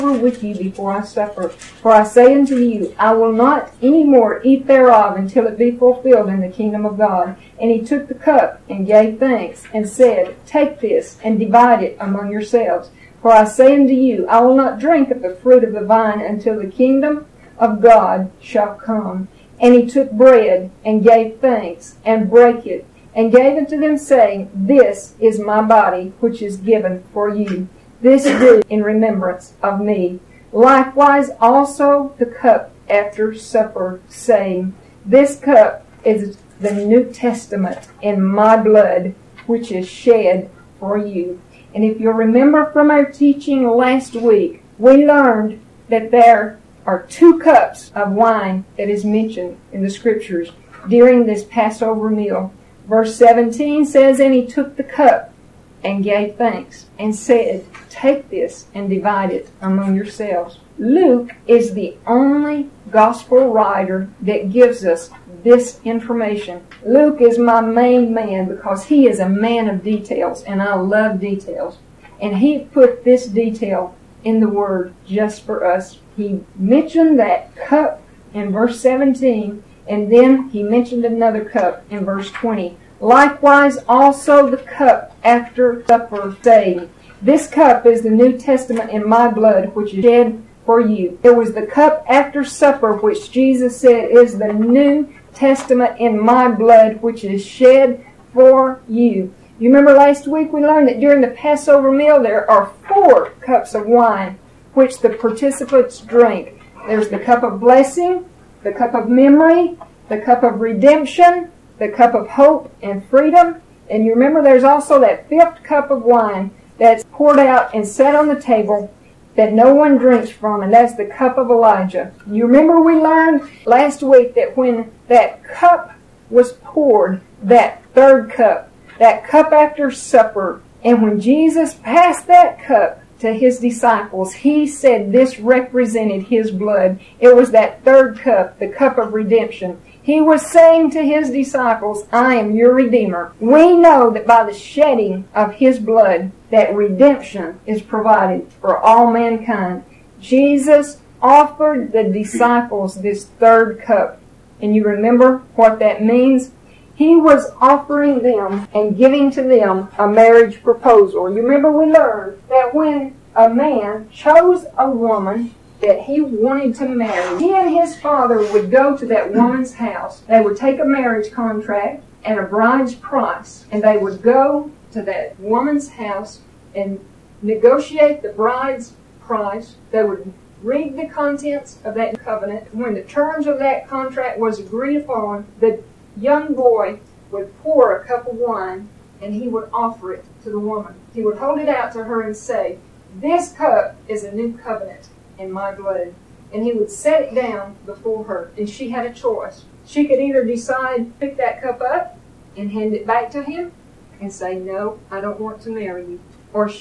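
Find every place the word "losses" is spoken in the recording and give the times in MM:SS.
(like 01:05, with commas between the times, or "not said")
not said.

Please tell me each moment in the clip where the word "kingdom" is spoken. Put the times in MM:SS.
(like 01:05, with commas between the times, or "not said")
00:06, 00:16.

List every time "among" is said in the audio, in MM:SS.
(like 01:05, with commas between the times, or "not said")
00:11, 00:59.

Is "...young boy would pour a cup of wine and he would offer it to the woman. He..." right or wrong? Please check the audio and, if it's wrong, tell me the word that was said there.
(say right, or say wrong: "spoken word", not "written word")
right.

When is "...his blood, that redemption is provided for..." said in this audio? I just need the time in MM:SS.
02:25.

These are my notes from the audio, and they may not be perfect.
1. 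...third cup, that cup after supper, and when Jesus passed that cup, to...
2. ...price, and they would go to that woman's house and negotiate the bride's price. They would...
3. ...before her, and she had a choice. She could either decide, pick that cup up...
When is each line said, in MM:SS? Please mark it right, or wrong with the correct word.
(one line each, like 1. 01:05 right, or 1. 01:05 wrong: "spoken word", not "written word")
1. 02:07 right
2. 02:52 right
3. 03:17 right.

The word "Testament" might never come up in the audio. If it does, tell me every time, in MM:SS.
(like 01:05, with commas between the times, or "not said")
00:37, 01:28, 01:35.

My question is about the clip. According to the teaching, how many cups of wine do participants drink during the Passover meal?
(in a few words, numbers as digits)
4.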